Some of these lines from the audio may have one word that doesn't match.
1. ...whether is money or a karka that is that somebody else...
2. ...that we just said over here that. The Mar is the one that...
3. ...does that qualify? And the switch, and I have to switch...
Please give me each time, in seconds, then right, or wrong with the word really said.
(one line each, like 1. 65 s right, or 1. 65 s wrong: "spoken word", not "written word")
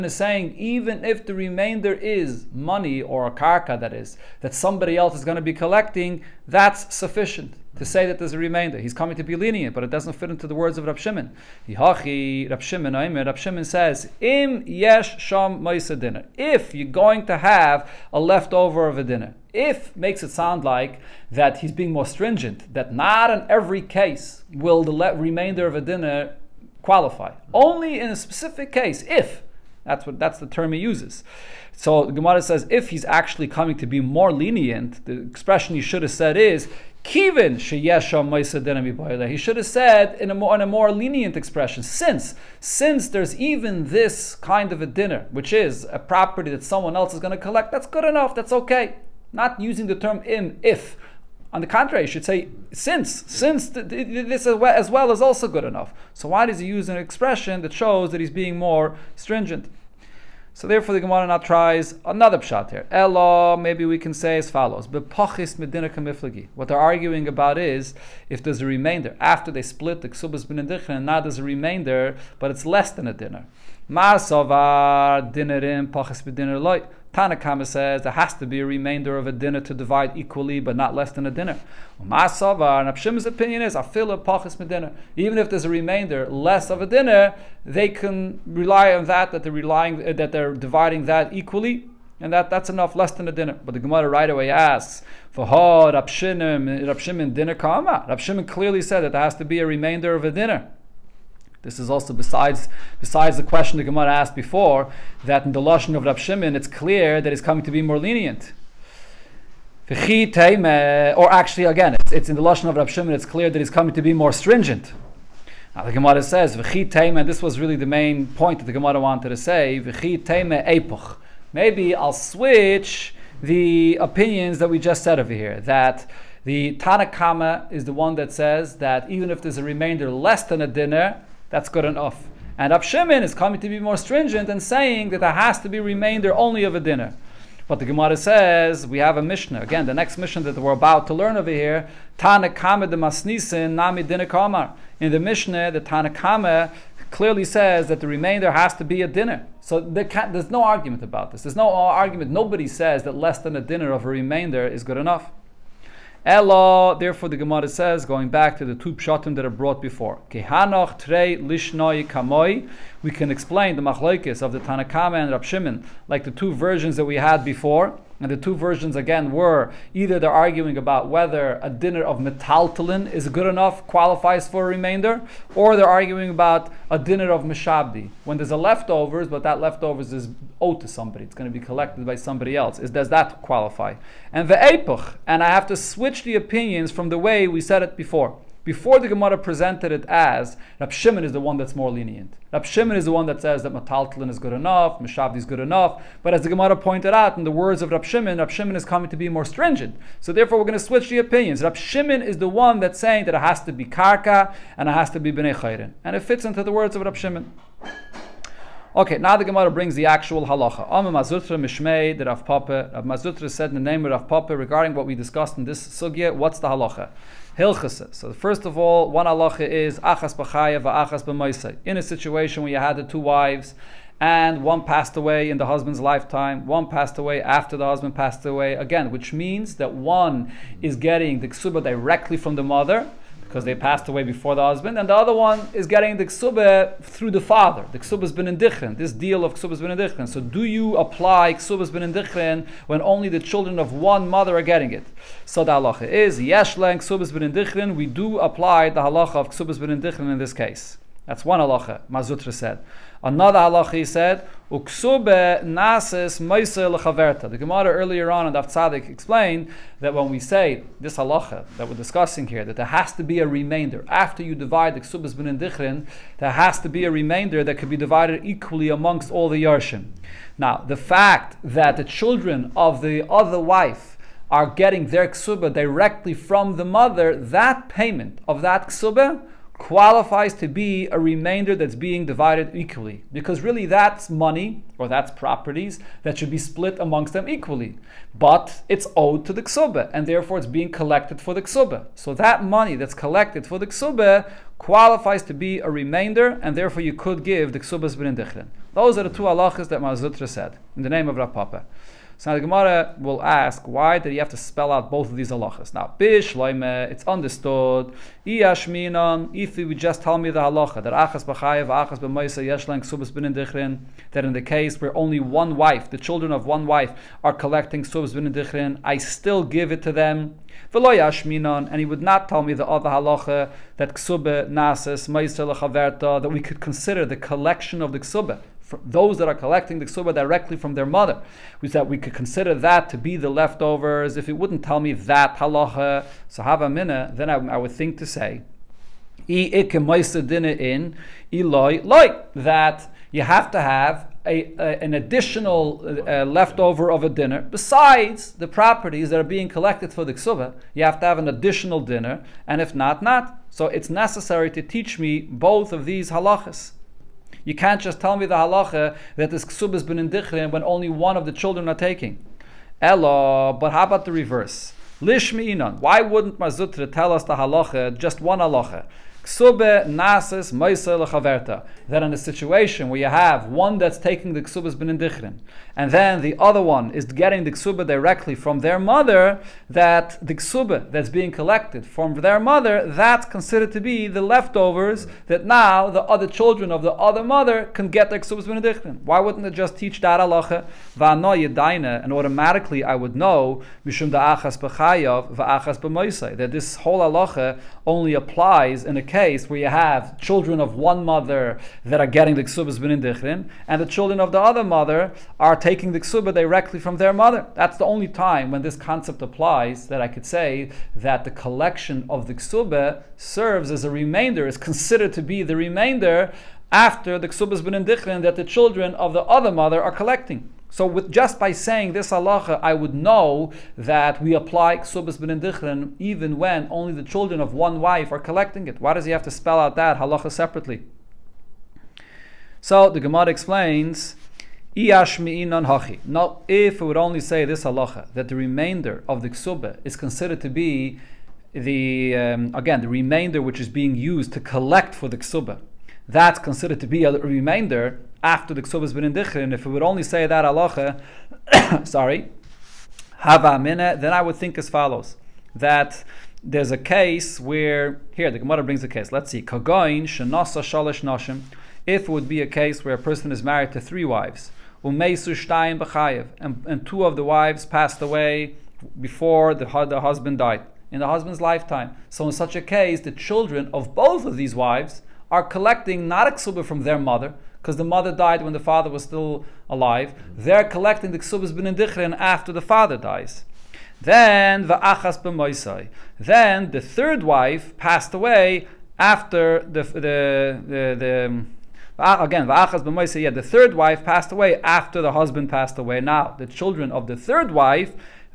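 1. 1 s wrong: "remainder", not "whether"
2. 124 s wrong: "Tanakama", not "Mar"
3. 182 s wrong: "epoch", not "switch".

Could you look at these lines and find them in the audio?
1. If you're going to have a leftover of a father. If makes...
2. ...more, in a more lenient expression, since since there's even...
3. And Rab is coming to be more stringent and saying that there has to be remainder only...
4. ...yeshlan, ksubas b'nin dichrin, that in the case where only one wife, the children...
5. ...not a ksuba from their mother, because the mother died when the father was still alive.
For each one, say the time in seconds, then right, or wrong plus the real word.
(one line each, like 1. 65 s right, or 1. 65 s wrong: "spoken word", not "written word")
1. 16 s wrong: "dinner", not "father"
2. 40 s right
3. 132 s right
4. 312 s right
5. 476 s right.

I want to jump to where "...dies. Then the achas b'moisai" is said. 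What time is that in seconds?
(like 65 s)
483 s.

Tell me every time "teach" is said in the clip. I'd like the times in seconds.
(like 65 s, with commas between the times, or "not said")
354 s, 389 s.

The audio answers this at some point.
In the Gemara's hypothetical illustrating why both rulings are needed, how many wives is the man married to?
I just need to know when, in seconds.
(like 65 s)
460 s.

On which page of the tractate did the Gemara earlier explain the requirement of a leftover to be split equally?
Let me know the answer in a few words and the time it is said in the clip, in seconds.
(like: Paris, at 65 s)
Daf Tzadik, at 258 s.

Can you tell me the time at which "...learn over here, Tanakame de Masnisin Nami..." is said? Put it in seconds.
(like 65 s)
141 s.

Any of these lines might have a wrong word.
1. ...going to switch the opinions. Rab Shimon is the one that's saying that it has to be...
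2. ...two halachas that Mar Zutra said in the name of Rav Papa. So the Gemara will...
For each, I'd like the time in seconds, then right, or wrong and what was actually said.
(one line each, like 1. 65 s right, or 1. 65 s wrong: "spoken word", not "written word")
1. 200 s right
2. 299 s right.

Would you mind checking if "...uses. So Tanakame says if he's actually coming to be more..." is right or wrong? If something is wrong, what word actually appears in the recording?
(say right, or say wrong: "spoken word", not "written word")
wrong: "Gemara", not "Tanakame".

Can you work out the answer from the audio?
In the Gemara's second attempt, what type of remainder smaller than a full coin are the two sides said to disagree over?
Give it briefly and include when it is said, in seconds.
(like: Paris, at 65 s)
Pachis medina, at 64 s.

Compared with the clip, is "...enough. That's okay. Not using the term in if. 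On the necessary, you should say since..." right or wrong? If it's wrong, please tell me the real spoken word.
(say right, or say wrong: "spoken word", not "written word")
wrong: "contrary", not "necessary".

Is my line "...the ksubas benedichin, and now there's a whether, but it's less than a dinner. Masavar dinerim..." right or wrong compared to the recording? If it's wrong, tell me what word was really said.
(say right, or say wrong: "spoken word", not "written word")
wrong: "remainder", not "whether".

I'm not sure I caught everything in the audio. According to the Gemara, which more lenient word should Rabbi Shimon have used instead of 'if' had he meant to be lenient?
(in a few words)
Kivin.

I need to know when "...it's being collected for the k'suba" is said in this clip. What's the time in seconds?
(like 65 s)
290 s.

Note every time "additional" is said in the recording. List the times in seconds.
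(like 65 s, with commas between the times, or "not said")
345 s, 351 s.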